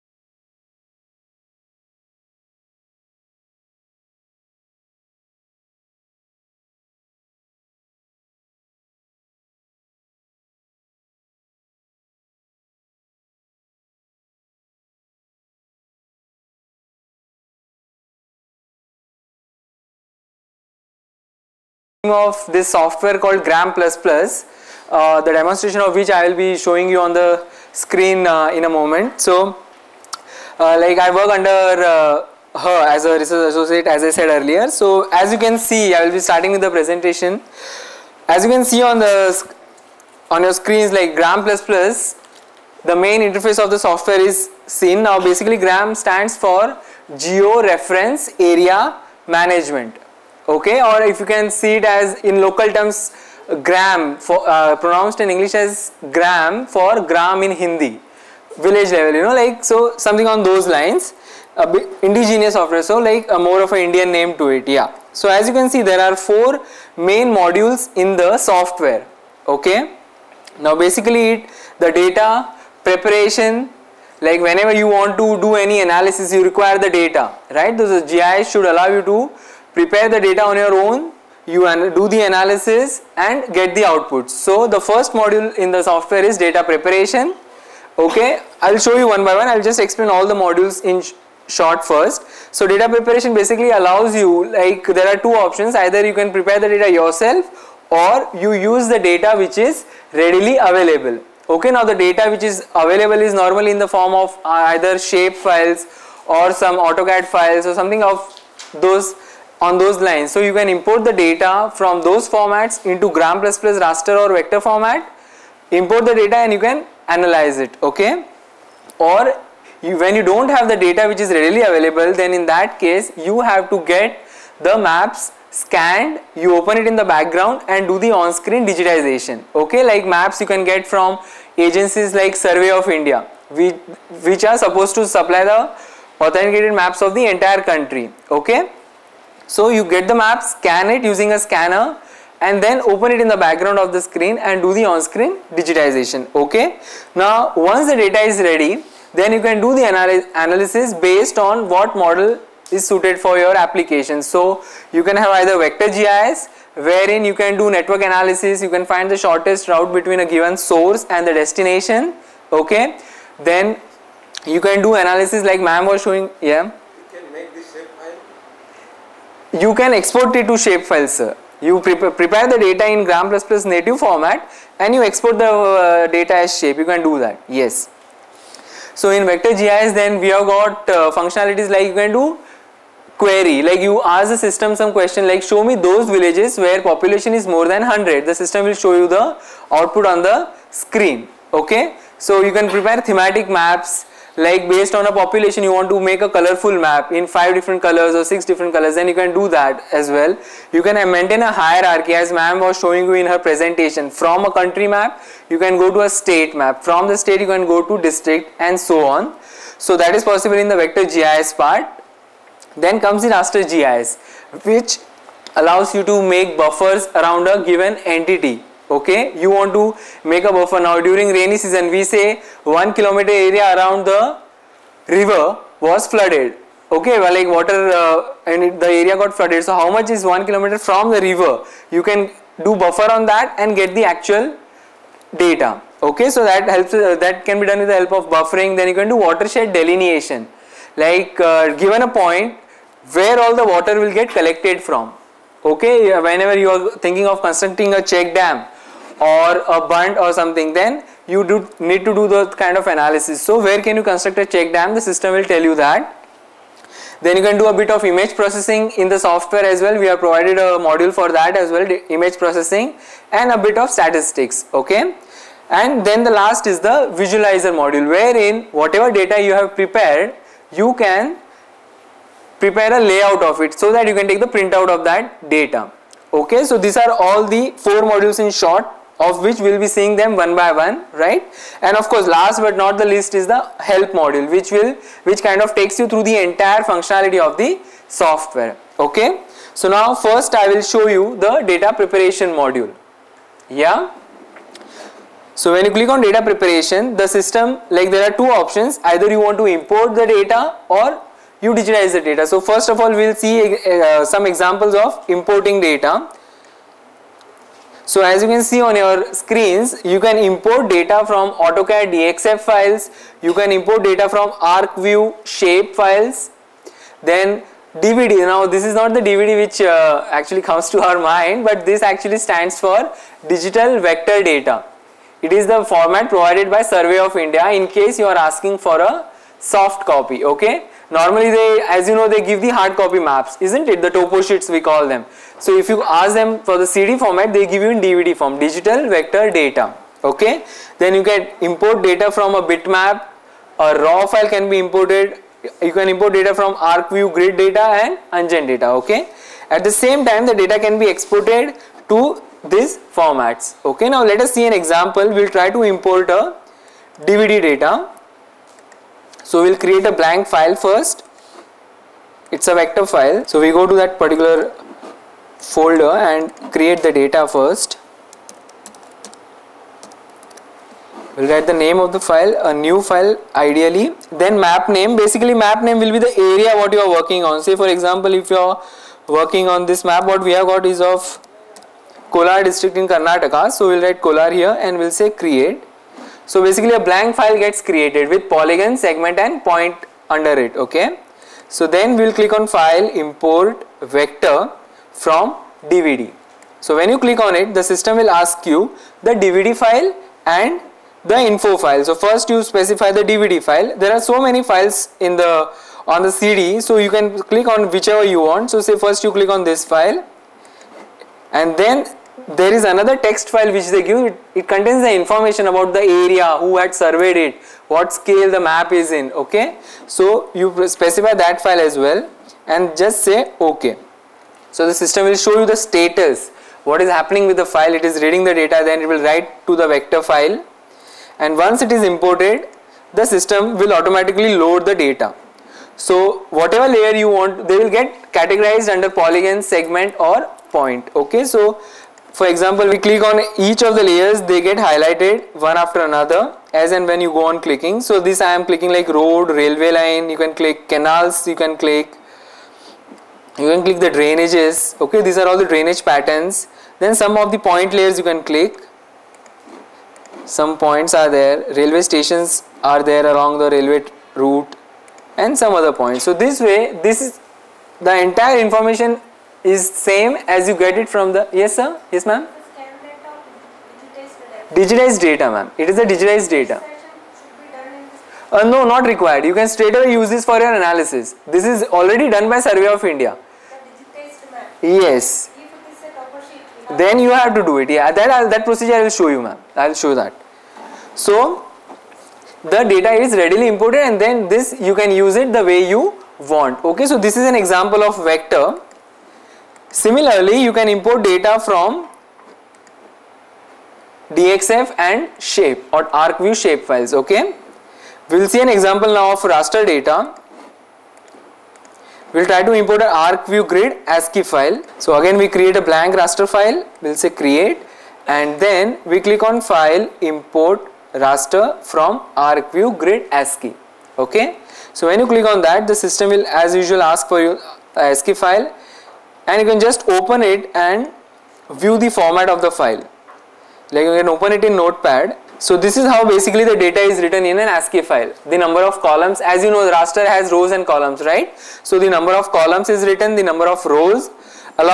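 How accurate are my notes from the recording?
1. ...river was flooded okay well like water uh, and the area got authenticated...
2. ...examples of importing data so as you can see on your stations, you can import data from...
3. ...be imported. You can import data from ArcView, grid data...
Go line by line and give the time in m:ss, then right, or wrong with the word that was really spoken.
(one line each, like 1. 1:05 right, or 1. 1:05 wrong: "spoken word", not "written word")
1. 3:45 wrong: "flooded", not "authenticated"
2. 5:04 wrong: "screens", not "stations"
3. 5:44 right.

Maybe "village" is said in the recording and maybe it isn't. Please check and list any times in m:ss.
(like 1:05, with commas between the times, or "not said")
0:58, 3:06.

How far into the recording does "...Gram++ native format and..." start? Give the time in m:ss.
2:53.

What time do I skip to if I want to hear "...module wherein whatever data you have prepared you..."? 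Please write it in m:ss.
4:27.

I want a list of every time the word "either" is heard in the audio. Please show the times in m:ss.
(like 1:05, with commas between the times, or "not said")
1:35, 1:44, 2:35, 4:59.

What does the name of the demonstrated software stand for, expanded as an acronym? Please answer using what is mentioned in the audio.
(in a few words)
Geo Reference Area Management.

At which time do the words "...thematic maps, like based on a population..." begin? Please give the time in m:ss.
3:13.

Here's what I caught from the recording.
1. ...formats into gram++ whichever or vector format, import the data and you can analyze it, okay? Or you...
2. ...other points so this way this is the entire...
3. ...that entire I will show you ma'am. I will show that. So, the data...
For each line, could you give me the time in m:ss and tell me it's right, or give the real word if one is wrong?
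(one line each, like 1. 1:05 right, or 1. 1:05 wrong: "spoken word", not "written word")
1. 1:52 wrong: "raster", not "whichever"
2. 7:45 right
3. 8:08 wrong: "procedure", not "entire".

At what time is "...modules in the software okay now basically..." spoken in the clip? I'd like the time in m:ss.
1:07.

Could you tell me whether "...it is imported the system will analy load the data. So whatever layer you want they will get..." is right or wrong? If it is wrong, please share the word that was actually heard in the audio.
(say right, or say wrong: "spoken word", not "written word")
wrong: "automatically", not "analy".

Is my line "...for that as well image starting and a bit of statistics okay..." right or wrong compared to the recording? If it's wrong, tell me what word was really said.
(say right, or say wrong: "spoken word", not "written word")
wrong: "processing", not "starting".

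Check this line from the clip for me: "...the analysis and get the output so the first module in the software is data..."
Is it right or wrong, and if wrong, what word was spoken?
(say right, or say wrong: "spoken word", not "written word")
right.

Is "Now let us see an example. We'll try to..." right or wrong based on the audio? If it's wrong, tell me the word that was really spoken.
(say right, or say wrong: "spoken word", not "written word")
right.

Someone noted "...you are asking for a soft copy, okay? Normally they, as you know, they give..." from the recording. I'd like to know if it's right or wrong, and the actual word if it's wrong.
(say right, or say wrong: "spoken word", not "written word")
right.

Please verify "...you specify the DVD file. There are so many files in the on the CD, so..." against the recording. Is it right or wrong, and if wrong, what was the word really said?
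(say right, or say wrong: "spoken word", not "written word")
right.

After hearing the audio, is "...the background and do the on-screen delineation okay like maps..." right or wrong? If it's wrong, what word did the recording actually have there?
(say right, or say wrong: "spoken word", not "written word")
wrong: "digitization", not "delineation".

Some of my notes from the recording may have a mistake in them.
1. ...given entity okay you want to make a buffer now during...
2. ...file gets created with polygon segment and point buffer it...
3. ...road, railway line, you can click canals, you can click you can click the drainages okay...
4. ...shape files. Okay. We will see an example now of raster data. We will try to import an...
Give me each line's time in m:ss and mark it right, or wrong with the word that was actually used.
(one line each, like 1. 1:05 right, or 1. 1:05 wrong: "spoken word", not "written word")
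1. 3:37 right
2. 6:27 wrong: "under", not "buffer"
3. 7:29 right
4. 8:26 right.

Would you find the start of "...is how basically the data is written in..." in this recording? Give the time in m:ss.
8:55.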